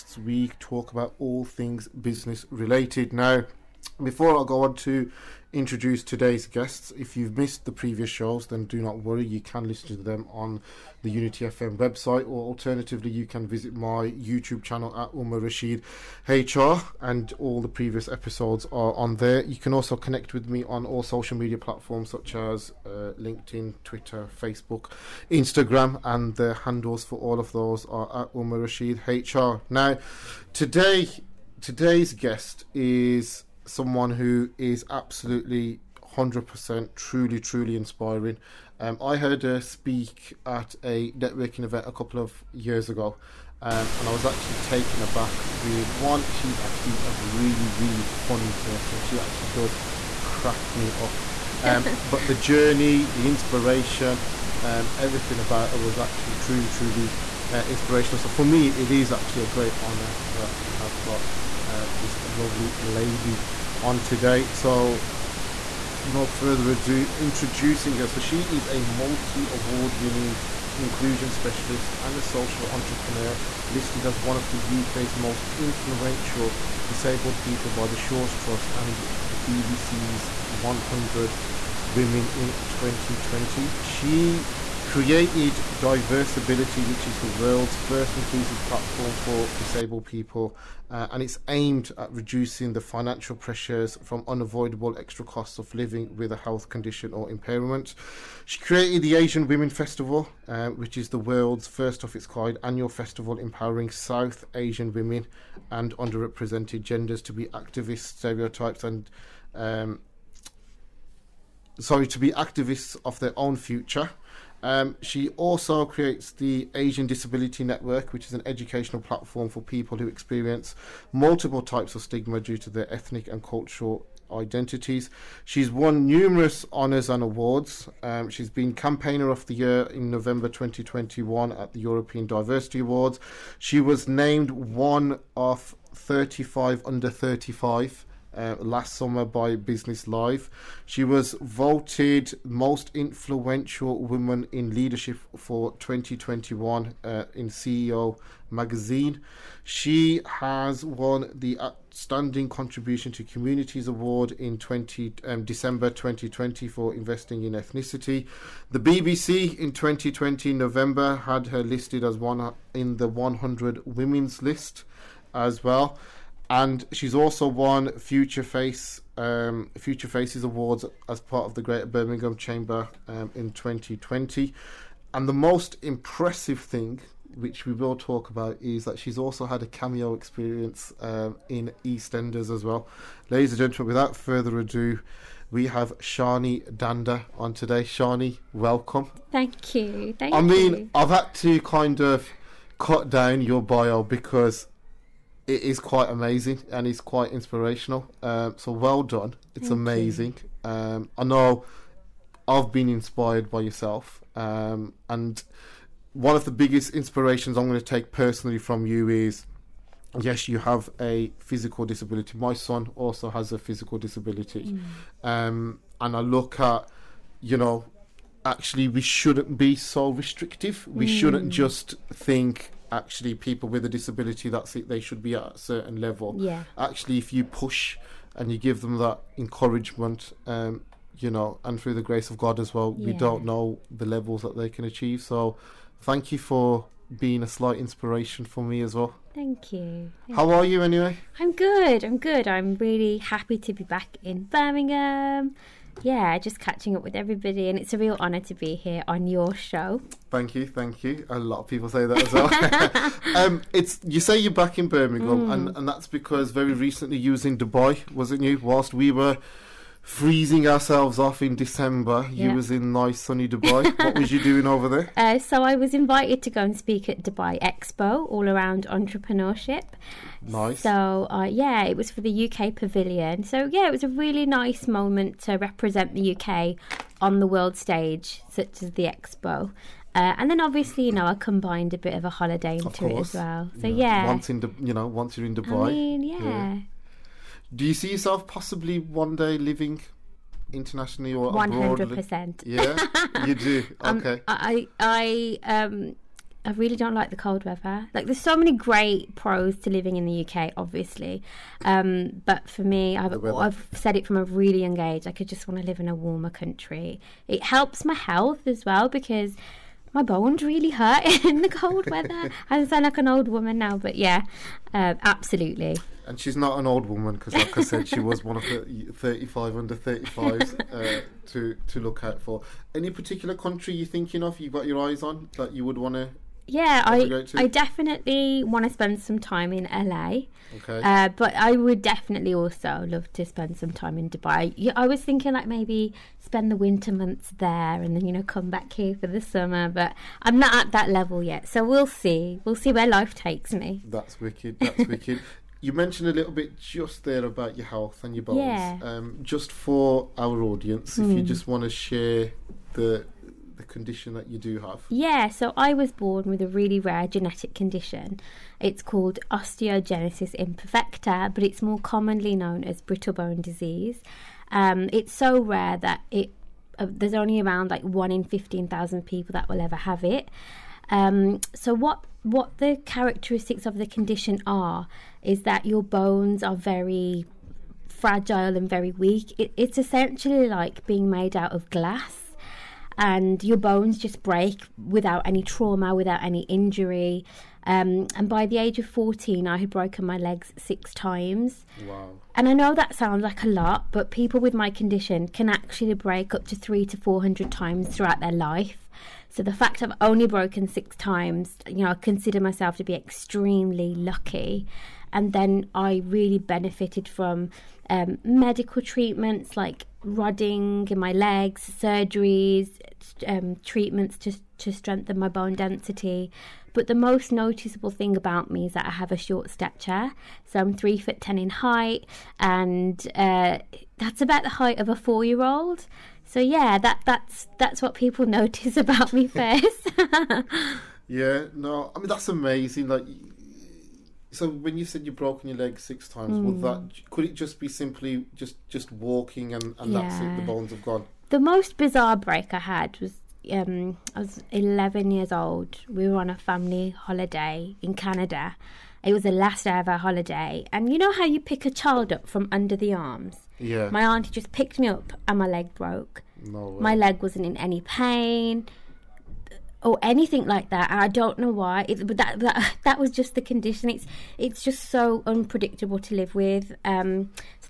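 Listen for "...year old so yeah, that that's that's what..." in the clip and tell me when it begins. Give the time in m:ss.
7:05.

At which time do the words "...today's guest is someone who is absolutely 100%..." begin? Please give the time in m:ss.
0:31.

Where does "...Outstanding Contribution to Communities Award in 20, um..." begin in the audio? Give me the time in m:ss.
2:31.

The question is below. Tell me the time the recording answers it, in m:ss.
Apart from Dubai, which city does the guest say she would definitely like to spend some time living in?
5:29.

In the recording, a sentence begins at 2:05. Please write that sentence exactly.
She's won numerous honours and awards.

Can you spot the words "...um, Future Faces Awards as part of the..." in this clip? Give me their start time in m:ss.
2:49.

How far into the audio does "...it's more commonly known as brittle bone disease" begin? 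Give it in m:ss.
6:01.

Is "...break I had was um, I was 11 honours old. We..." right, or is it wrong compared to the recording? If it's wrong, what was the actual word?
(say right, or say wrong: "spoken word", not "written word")
wrong: "years", not "honours".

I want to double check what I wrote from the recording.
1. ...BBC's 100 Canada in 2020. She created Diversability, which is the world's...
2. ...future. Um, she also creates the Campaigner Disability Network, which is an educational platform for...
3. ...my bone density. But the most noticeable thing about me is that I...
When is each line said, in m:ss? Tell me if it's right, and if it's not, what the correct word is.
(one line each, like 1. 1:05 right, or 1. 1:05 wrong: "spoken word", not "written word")
1. 1:19 wrong: "Women", not "Canada"
2. 1:53 wrong: "Asian", not "Campaigner"
3. 6:55 right.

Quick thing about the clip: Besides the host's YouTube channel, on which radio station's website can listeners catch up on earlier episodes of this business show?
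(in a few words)
Unity FM.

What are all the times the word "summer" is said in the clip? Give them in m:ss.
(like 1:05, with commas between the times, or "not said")
2:18, 5:39.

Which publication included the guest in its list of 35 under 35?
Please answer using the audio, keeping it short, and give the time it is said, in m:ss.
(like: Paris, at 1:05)
Business Life, at 2:19.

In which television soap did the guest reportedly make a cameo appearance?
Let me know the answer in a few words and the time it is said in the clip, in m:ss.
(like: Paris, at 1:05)
EastEnders, at 3:01.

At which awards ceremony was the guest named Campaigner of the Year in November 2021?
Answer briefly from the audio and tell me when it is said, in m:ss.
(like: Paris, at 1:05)
European Diversity Awards, at 2:11.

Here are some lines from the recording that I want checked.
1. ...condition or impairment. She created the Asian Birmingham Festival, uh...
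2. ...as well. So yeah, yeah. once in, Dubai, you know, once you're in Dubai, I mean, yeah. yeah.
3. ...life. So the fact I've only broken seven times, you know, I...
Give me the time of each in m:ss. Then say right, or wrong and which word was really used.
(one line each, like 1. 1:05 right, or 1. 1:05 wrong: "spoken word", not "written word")
1. 1:36 wrong: "Women", not "Birmingham"
2. 4:43 right
3. 6:38 wrong: "six", not "seven".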